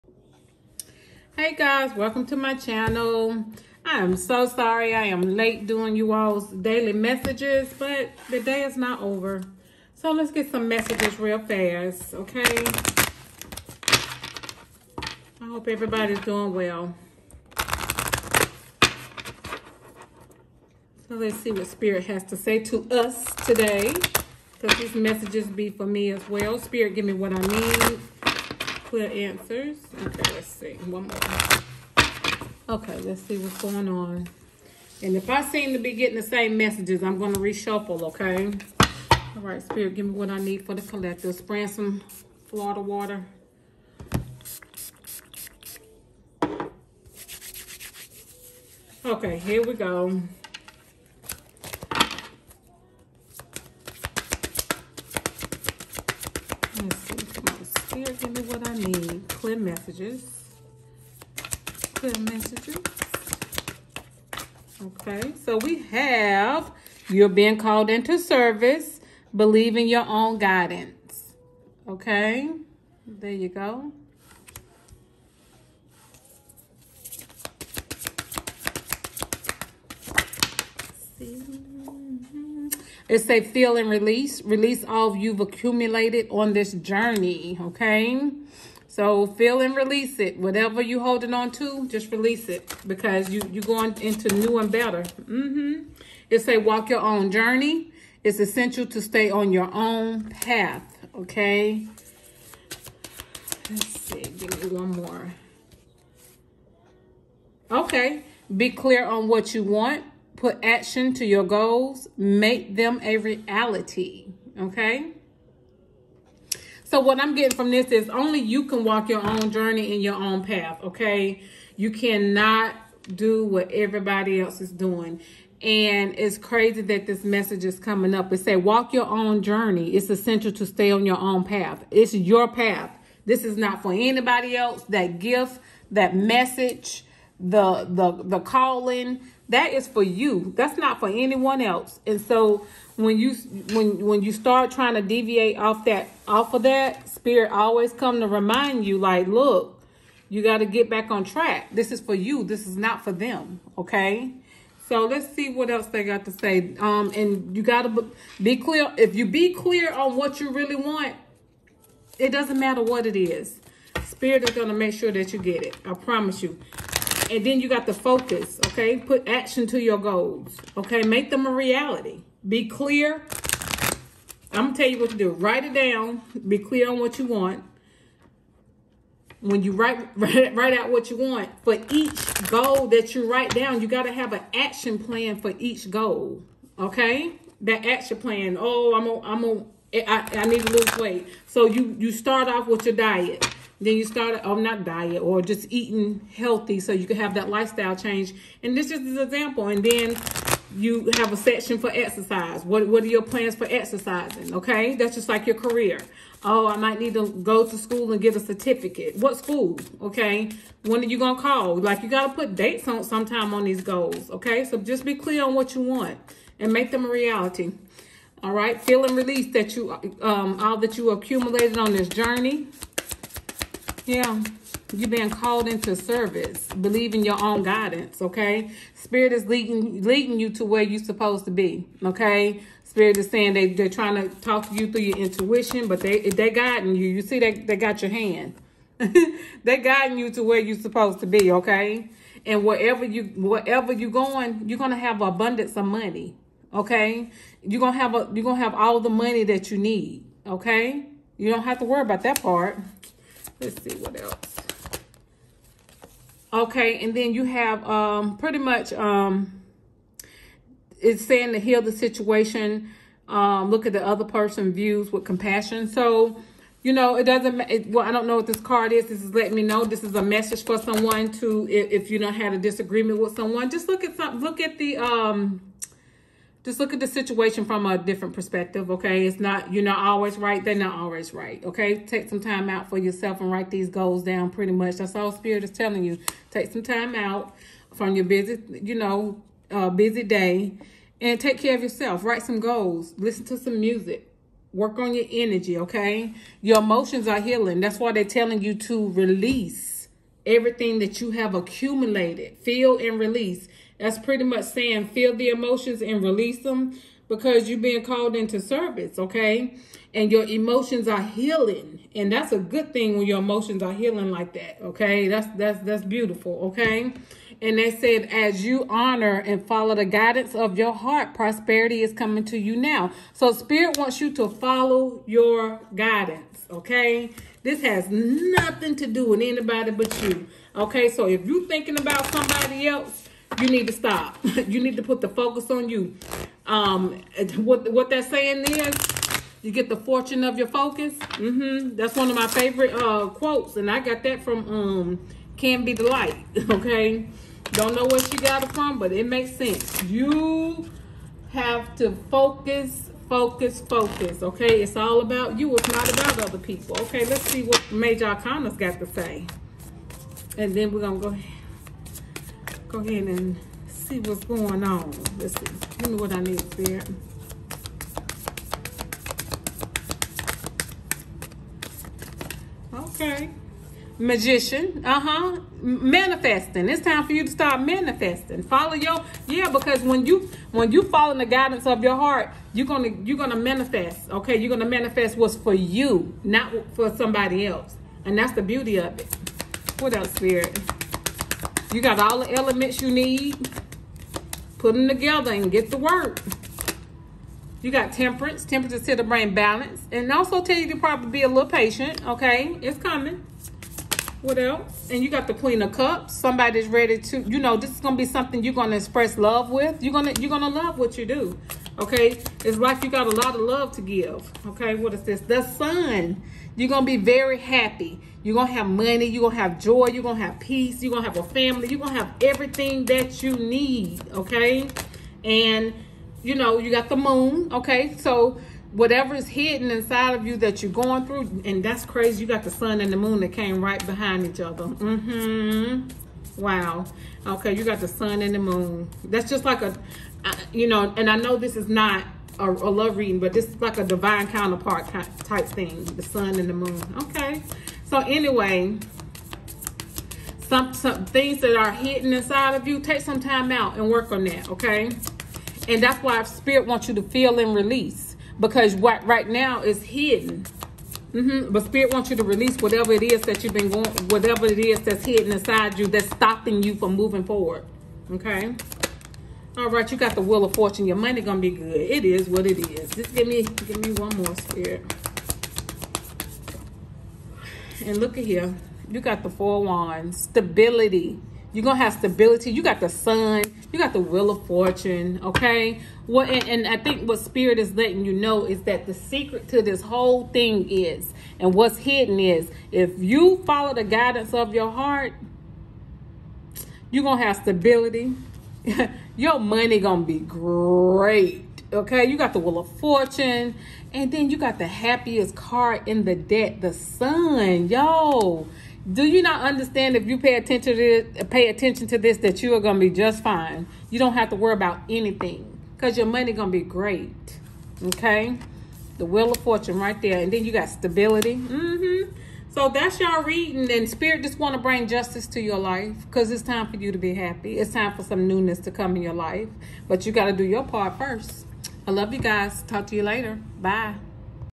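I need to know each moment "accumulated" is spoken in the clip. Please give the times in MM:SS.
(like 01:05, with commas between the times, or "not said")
01:25, 03:41, 05:01.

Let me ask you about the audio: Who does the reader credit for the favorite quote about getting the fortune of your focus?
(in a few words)
Can Be the Light.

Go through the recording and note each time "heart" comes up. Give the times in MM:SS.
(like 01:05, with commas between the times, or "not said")
05:20, 06:22, 08:14.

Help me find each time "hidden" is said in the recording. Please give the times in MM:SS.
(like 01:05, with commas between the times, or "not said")
07:09, 07:31, 07:40, 07:45, 08:11.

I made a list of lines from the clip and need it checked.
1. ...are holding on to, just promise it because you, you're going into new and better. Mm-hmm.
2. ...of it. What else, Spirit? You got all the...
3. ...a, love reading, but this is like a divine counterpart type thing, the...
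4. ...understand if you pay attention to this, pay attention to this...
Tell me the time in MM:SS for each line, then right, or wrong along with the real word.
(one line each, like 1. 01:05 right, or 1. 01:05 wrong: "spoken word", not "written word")
1. 01:30 wrong: "release", not "promise"
2. 06:28 right
3. 07:22 right
4. 08:29 right.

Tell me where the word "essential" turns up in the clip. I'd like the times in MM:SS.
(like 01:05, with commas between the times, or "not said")
01:38, 02:10.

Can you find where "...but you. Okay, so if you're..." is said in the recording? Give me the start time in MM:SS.
05:29.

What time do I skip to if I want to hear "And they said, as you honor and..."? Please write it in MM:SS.
05:17.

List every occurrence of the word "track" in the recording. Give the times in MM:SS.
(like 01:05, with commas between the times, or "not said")
02:31.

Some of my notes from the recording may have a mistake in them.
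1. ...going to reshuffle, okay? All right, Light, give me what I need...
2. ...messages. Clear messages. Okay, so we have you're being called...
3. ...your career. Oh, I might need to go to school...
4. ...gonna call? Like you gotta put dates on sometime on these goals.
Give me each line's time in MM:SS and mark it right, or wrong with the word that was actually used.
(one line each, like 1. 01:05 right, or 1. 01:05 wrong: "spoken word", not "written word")
1. 00:37 wrong: "Spirit", not "Light"
2. 00:59 right
3. 03:25 right
4. 03:31 right.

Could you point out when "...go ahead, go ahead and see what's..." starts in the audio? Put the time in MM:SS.
06:01.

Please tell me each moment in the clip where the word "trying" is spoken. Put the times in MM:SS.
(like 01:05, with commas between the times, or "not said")
02:24, 03:53.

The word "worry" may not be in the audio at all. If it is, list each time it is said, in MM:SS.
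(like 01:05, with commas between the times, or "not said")
04:11, 08:34.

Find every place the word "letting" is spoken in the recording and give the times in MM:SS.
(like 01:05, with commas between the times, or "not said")
04:29, 08:07.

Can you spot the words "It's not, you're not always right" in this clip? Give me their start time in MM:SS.
04:39.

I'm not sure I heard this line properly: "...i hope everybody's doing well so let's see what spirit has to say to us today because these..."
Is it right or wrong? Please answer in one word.
right.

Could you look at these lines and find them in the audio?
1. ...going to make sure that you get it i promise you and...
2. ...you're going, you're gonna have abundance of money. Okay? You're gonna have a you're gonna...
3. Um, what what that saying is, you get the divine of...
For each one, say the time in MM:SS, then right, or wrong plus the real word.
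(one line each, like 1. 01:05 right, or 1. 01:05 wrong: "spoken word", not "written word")
1. 02:44 right
2. 04:03 right
3. 05:36 wrong: "fortune", not "divine".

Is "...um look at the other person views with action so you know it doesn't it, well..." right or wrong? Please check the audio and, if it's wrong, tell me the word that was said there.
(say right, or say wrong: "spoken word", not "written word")
wrong: "compassion", not "action".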